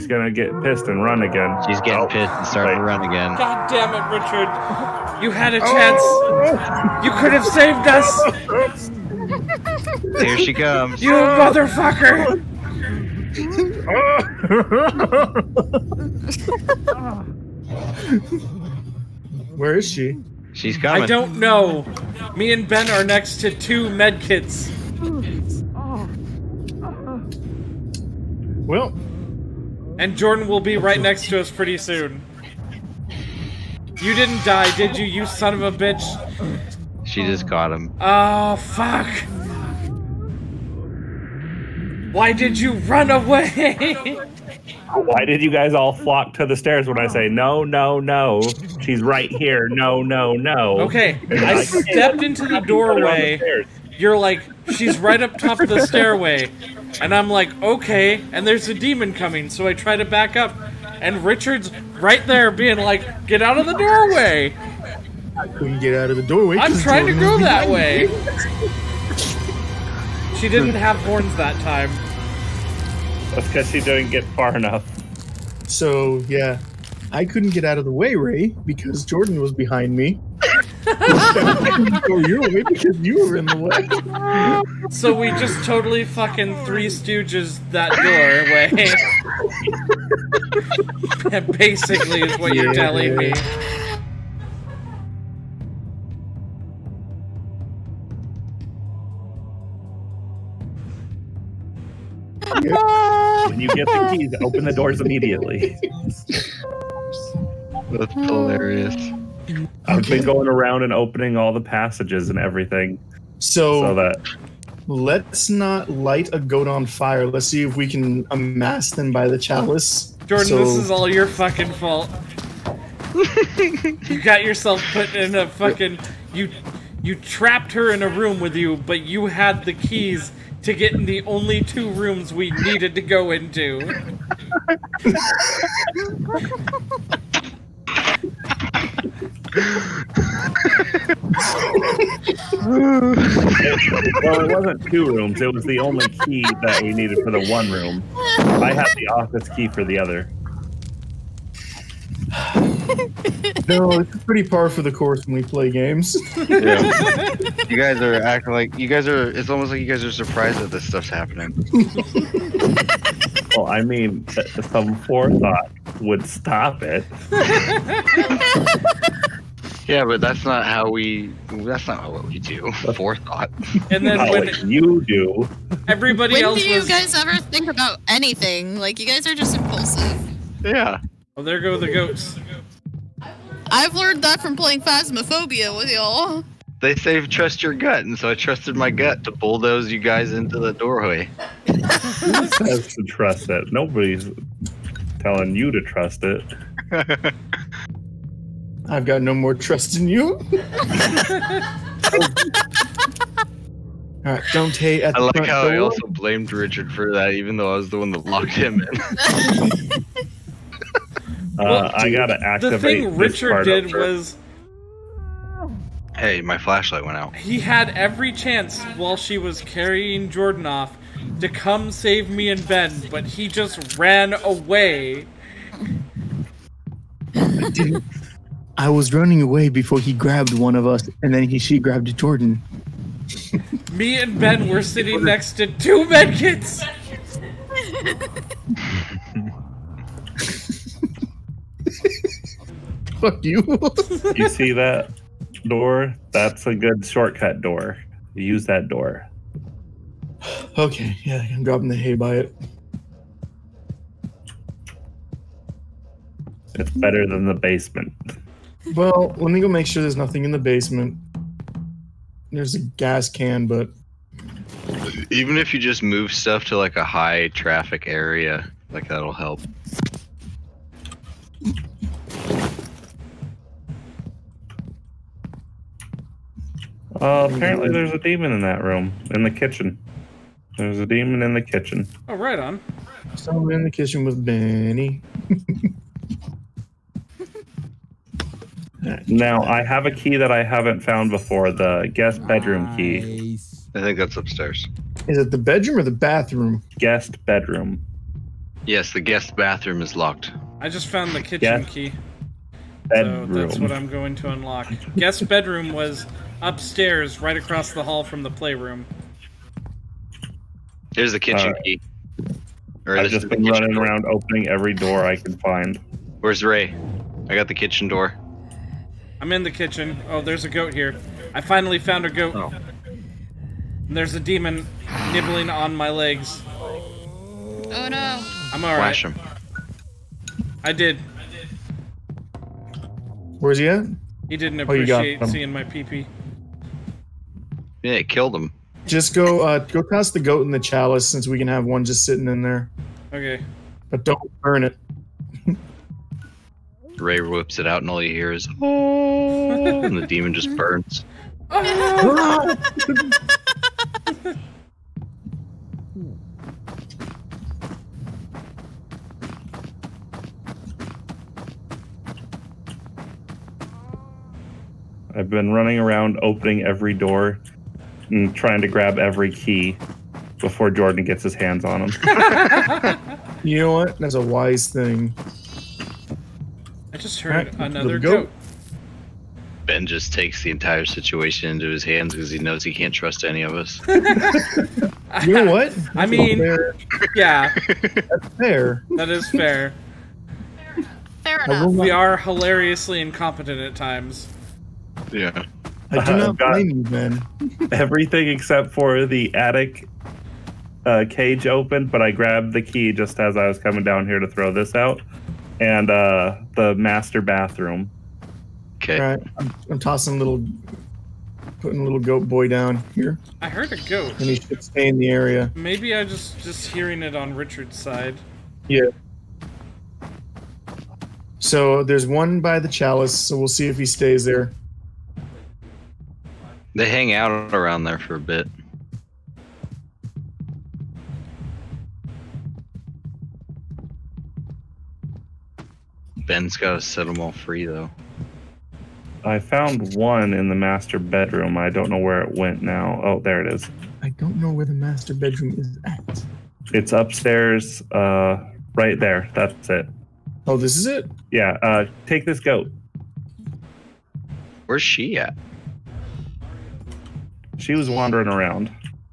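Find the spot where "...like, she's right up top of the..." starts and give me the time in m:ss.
0:54.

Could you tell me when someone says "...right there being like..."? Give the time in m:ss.
1:01.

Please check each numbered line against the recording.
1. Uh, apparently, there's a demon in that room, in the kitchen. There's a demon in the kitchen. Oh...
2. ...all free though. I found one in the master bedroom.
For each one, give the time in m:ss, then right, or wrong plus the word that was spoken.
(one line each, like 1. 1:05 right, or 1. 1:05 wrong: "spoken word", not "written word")
1. 4:37 right
2. 7:17 right.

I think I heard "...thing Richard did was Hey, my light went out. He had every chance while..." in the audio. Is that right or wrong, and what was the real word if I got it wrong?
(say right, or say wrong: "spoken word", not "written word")
wrong: "flashlight", not "light".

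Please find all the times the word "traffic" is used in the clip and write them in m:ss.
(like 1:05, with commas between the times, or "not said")
4:27.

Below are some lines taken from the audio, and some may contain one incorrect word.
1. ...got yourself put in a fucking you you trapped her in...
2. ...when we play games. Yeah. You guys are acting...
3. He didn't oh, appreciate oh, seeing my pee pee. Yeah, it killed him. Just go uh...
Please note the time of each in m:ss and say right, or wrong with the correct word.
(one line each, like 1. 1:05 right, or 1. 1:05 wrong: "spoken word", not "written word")
1. 2:04 right
2. 2:35 right
3. 5:34 right.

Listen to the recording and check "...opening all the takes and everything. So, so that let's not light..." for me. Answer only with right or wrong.
wrong.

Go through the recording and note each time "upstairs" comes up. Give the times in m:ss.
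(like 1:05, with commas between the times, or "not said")
4:54, 5:06, 7:27.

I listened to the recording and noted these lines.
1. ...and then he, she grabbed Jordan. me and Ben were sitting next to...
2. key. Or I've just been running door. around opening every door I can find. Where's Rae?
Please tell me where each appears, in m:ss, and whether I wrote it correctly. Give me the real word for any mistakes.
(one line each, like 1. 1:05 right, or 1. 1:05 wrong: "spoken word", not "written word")
1. 3:51 right
2. 5:11 right.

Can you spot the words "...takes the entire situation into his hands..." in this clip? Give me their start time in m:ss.
6:20.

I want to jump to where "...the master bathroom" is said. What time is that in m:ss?
6:46.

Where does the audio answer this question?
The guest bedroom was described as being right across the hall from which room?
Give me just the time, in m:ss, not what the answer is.
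5:08.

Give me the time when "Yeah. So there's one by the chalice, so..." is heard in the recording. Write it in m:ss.
6:58.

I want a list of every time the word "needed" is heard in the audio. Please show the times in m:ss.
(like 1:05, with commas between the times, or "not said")
2:12, 2:26.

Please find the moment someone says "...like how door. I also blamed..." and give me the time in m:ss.
3:25.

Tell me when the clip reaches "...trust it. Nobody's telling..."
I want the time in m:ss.
3:13.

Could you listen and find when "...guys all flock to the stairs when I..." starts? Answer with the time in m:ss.
0:45.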